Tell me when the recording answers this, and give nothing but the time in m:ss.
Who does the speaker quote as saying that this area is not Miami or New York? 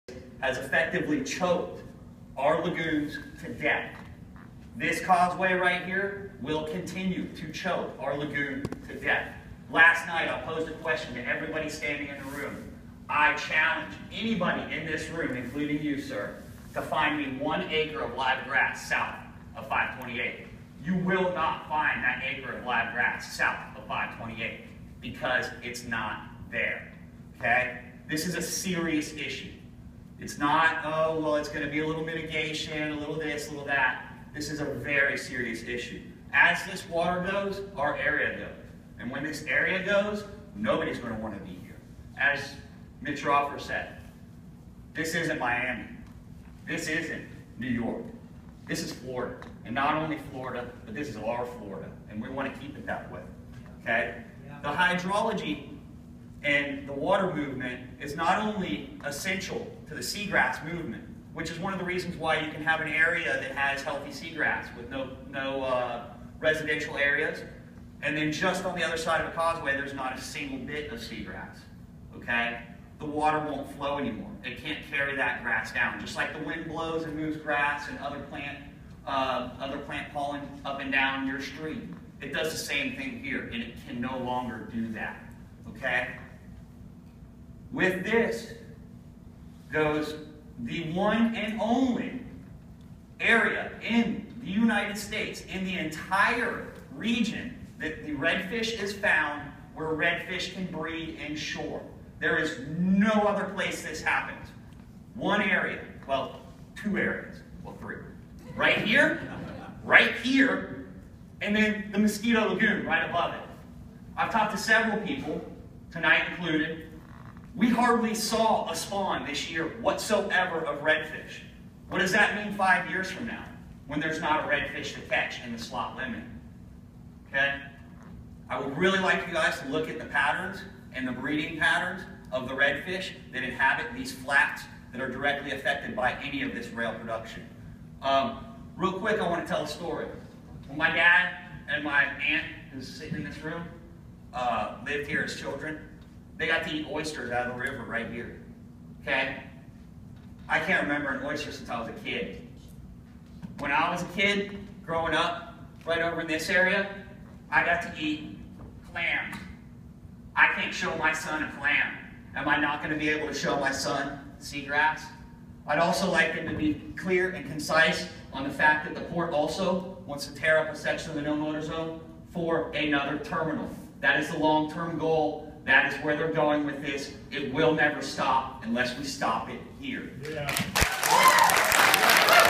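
0:43.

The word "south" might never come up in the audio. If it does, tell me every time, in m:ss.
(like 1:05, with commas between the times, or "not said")
0:18, 0:23.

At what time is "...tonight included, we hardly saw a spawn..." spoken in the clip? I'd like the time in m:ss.
1:55.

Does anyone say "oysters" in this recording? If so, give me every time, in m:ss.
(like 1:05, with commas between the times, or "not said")
2:26, 2:31.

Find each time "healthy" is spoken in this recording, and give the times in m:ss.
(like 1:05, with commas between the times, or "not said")
1:03.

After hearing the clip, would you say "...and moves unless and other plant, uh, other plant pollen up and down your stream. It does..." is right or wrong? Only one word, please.
wrong.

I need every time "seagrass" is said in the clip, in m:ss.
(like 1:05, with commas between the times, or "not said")
1:00, 1:04, 1:10, 2:44.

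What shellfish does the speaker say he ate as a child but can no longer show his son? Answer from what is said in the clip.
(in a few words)
Clams.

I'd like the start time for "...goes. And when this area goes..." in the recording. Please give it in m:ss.
0:38.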